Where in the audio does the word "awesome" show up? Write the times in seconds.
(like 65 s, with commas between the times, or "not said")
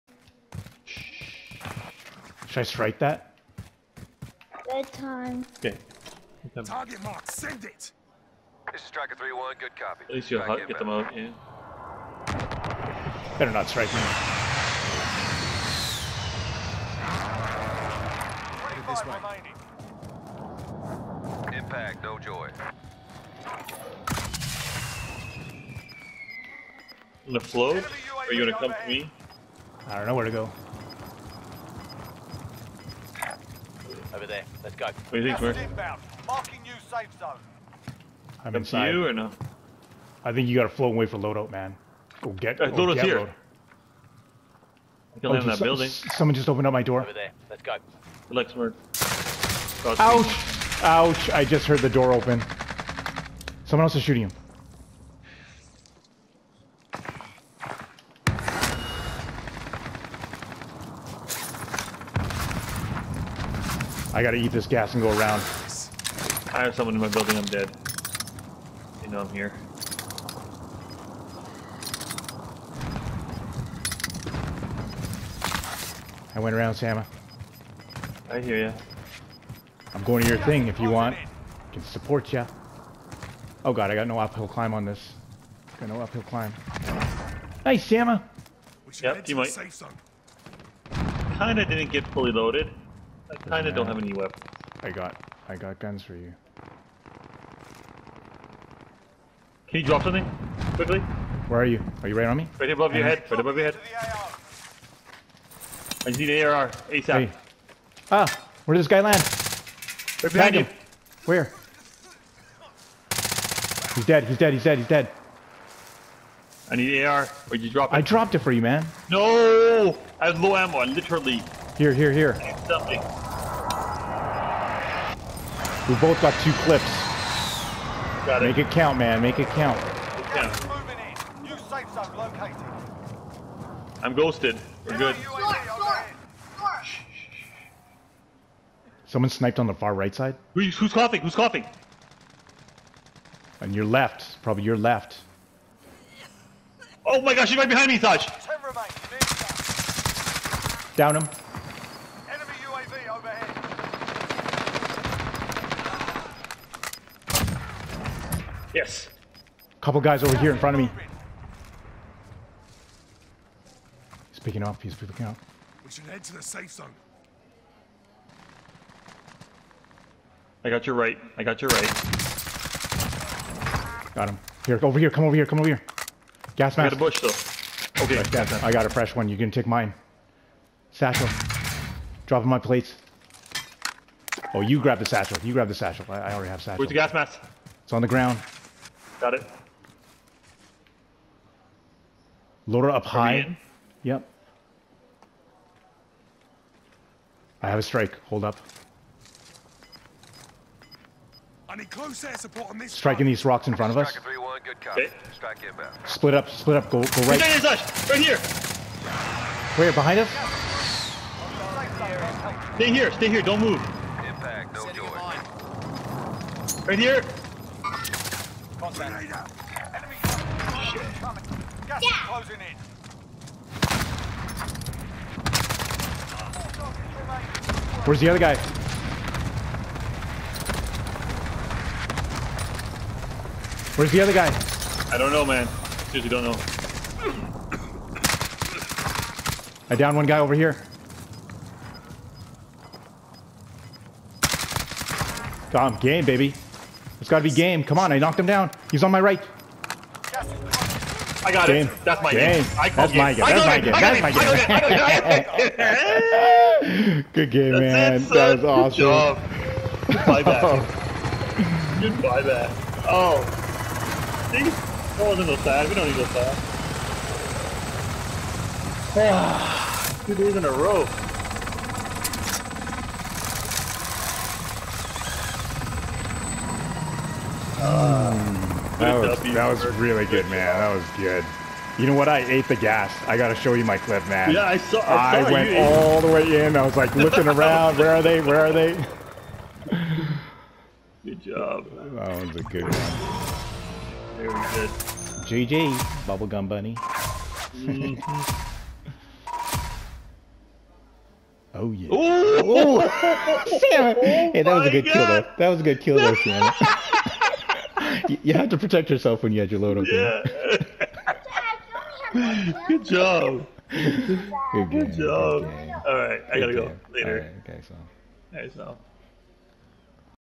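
258 s.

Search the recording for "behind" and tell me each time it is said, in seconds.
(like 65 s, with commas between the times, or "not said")
110 s, 147 s, 209 s.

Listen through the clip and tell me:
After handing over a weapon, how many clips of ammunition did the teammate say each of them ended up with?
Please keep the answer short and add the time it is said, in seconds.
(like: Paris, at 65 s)
2, at 125 s.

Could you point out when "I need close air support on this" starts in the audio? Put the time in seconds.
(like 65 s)
201 s.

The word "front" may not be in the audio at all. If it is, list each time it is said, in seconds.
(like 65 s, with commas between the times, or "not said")
160 s, 203 s.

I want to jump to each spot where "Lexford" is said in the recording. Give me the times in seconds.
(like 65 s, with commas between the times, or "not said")
48 s.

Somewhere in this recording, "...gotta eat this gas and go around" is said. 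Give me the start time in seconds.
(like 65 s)
64 s.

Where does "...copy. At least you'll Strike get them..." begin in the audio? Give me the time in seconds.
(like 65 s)
9 s.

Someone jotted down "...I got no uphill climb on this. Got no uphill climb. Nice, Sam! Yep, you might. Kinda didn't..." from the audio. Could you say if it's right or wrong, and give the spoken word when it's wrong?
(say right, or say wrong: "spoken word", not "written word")
right.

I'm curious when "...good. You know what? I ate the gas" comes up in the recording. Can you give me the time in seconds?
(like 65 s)
281 s.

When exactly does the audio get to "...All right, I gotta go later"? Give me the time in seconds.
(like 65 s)
316 s.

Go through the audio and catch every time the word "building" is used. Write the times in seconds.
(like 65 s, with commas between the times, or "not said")
45 s, 67 s.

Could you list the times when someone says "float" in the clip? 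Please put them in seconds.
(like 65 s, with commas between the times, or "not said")
27 s, 40 s.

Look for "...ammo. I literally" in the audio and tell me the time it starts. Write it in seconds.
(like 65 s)
120 s.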